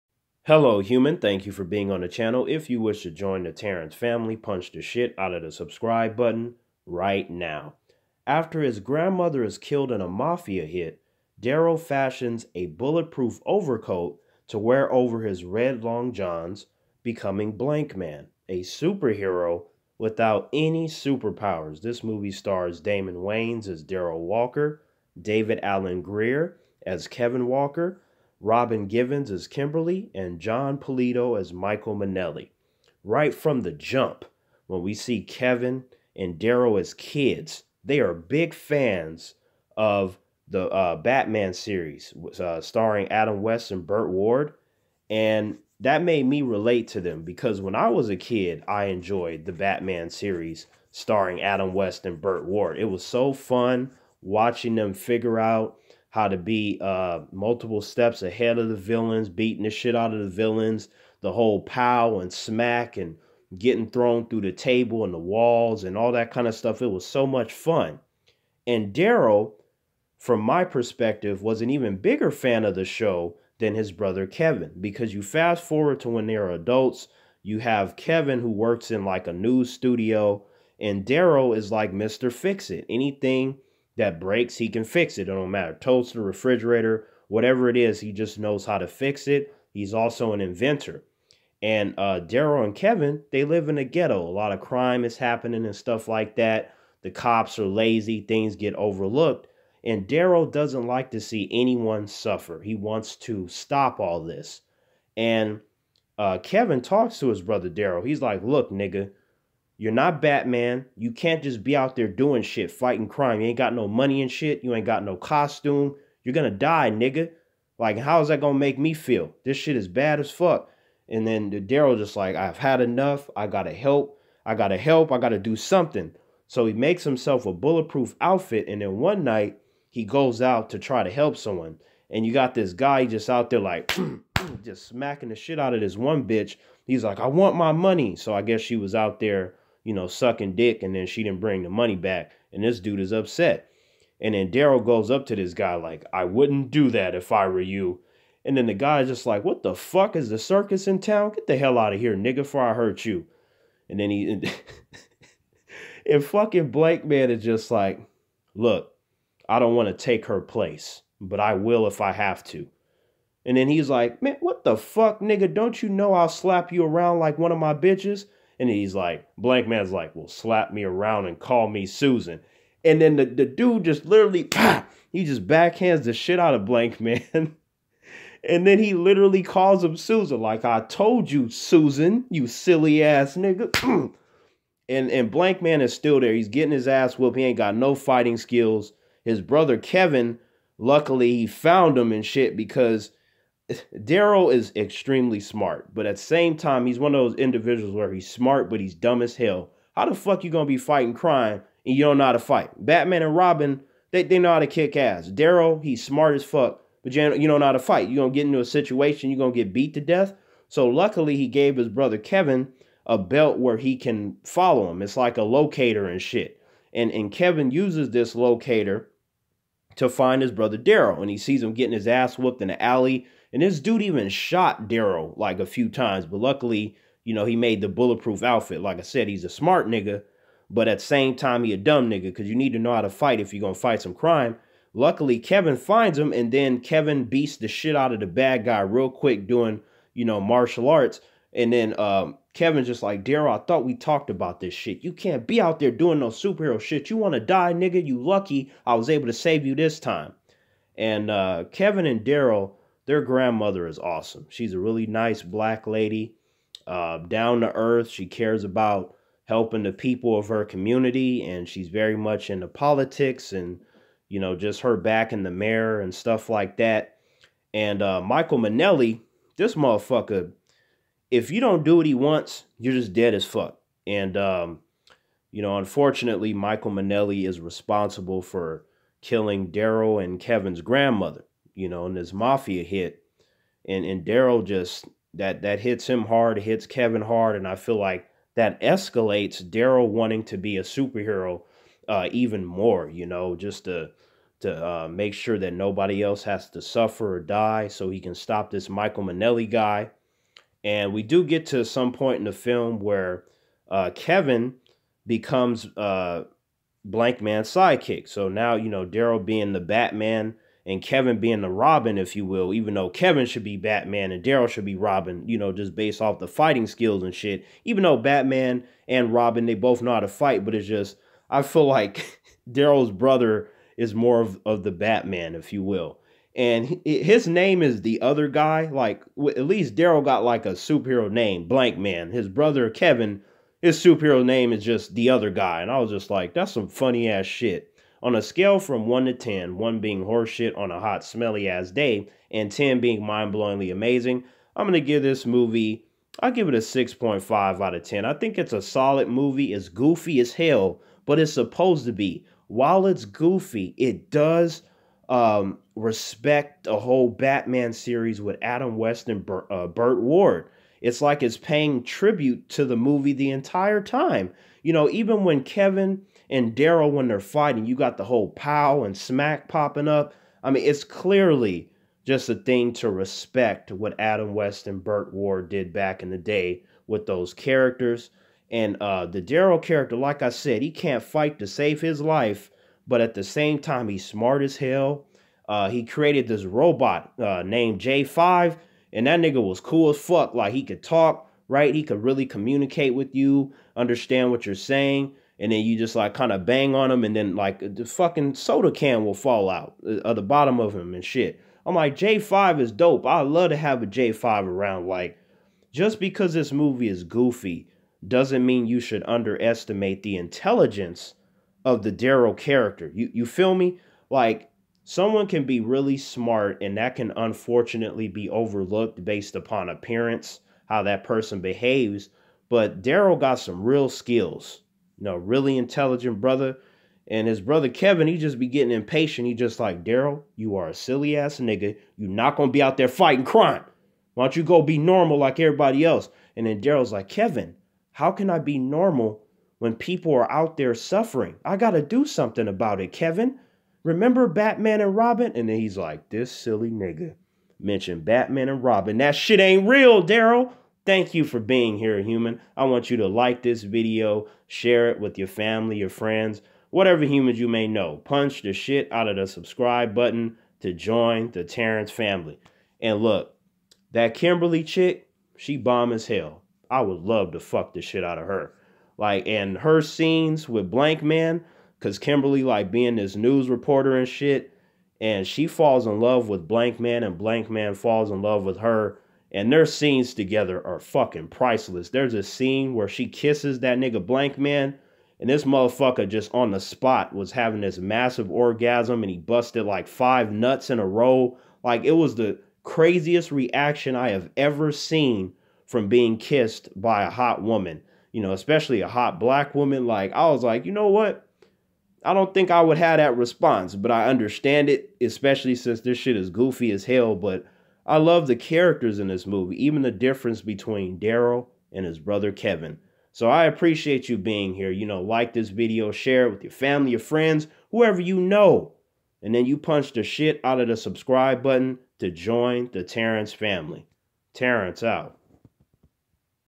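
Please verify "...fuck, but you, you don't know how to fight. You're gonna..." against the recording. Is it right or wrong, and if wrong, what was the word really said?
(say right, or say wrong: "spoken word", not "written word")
right.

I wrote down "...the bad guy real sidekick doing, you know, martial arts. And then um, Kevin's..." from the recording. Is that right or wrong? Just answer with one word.
wrong.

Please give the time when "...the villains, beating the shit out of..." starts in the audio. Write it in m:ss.
0:58.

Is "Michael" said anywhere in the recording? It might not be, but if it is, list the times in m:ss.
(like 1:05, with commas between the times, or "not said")
0:31, 4:28, 4:36, 4:58.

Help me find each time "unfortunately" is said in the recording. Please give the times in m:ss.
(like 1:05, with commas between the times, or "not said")
4:35, 6:57.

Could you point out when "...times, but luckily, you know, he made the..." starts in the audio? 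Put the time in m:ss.
3:45.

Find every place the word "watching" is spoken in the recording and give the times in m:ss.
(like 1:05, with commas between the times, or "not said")
0:54.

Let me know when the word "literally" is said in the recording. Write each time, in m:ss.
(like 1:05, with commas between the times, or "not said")
2:54, 2:58.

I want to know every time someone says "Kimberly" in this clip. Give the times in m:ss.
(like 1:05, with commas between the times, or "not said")
0:29, 7:44, 7:52.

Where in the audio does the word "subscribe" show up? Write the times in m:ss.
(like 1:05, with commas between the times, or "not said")
0:05, 7:39, 8:40.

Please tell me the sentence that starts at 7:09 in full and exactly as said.
He just like, Daryl, you are a silly ass nigga.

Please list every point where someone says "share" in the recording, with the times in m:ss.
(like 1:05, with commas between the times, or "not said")
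7:34, 8:36.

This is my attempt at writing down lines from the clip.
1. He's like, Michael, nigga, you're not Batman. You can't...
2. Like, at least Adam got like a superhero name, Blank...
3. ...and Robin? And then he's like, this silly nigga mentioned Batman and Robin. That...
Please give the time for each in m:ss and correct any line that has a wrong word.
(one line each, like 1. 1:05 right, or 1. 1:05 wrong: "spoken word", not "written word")
1. 1:48 wrong: "Look", not "Michael"
2. 5:28 wrong: "Daryl", not "Adam"
3. 7:25 right.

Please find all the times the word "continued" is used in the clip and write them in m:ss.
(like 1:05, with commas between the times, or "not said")
not said.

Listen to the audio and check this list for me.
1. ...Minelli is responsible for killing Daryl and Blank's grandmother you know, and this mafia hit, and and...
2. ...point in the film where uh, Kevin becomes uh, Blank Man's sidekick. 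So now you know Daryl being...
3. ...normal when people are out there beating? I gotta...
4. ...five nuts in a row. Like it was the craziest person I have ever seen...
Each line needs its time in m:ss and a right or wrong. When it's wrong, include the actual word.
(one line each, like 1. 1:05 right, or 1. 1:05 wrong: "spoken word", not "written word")
1. 4:36 wrong: "Kevin", not "Blank"
2. 5:02 right
3. 7:18 wrong: "suffering", not "beating"
4. 8:10 wrong: "reaction", not "person".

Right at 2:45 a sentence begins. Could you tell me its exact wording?
Don't you know I'll slap you around like one of my bitches?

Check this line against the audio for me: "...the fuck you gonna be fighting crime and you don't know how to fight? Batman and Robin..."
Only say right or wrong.
right.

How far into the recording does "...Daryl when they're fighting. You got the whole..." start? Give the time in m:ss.
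6:06.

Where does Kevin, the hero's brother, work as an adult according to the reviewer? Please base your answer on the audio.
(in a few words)
news studio.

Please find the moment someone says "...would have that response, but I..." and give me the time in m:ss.
8:22.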